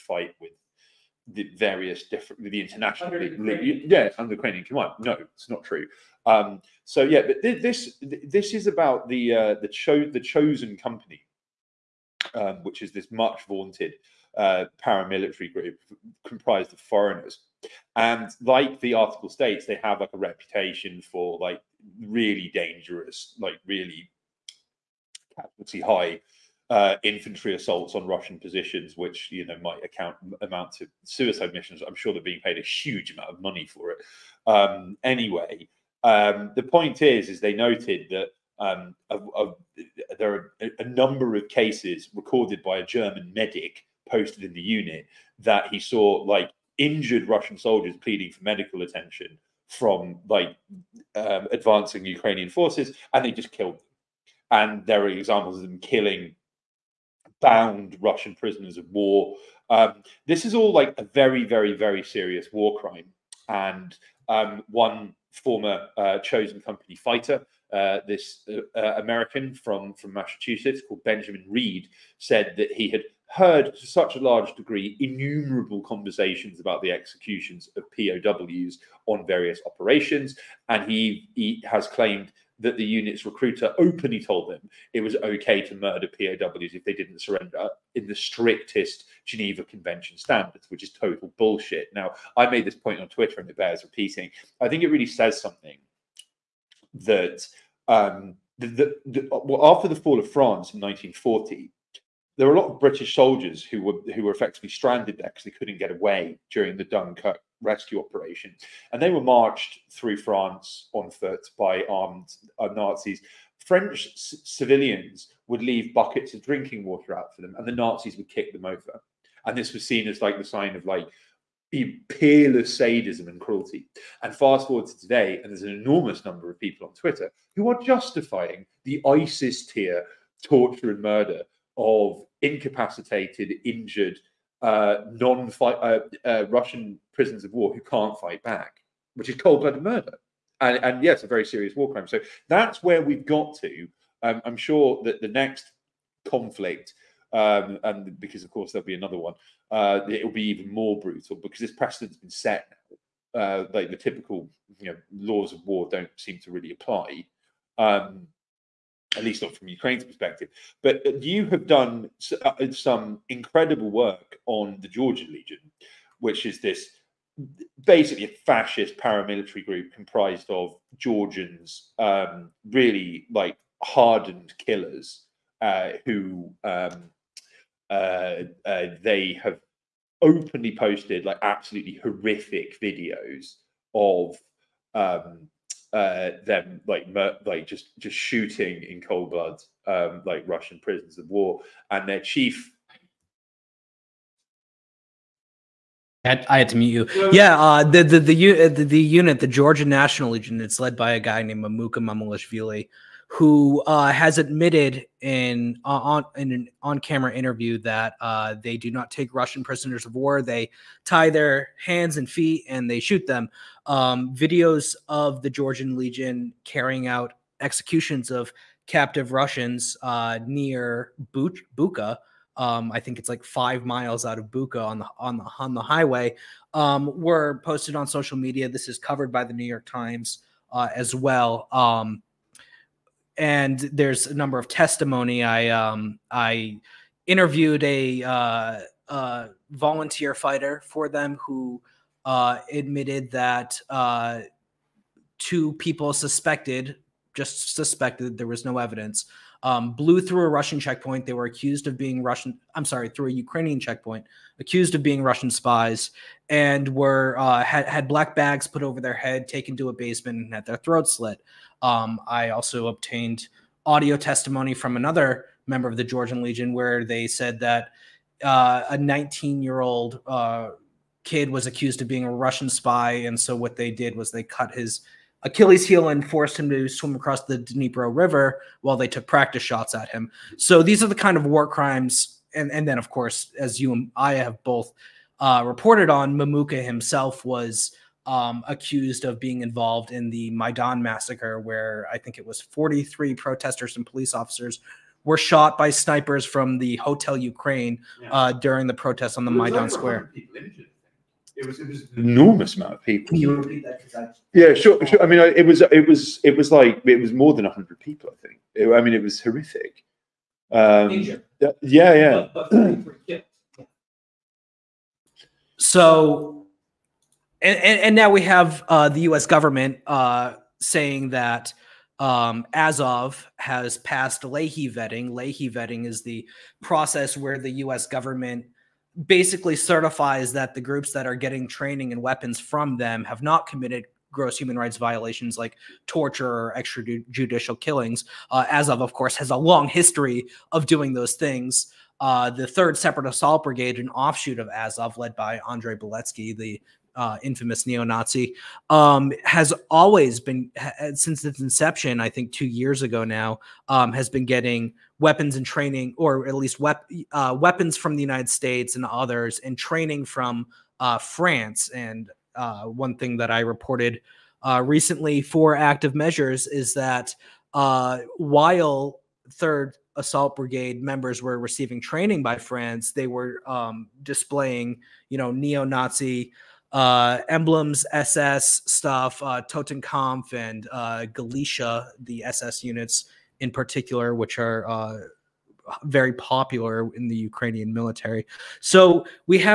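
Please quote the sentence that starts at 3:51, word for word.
Um, and there's a number of testimony.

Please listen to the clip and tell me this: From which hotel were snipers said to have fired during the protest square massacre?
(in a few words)
Hotel Ukraine.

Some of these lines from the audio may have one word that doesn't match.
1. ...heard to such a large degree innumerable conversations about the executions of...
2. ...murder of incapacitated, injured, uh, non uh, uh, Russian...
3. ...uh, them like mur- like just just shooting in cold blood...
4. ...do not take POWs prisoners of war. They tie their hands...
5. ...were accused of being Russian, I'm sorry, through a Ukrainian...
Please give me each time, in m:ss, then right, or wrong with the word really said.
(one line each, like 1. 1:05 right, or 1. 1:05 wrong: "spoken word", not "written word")
1. 1:13 right
2. 2:11 right
3. 3:05 right
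4. 3:28 wrong: "Russian", not "POWs"
5. 4:11 right.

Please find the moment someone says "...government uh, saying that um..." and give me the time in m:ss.
5:19.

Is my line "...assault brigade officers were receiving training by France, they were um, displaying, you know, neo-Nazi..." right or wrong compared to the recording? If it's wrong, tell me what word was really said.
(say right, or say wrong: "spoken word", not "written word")
wrong: "members", not "officers".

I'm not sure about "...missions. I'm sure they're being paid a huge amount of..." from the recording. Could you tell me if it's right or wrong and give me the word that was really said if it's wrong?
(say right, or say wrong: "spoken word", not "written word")
right.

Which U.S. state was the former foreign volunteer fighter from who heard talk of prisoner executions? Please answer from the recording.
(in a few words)
Massachusetts.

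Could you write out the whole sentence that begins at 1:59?
And this was seen as like the sign of like peerless sadism and cruelty.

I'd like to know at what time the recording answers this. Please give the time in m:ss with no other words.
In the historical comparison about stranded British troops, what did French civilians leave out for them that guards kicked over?
1:55.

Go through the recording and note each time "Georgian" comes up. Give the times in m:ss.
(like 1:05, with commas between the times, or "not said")
2:44, 2:50, 3:19, 3:35, 4:26.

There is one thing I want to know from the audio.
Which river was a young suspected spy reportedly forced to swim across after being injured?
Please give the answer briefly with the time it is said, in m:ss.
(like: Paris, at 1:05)
Dnipro River, at 4:37.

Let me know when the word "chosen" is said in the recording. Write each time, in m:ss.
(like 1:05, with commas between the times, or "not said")
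0:10, 1:06.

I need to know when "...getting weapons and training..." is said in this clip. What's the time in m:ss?
5:54.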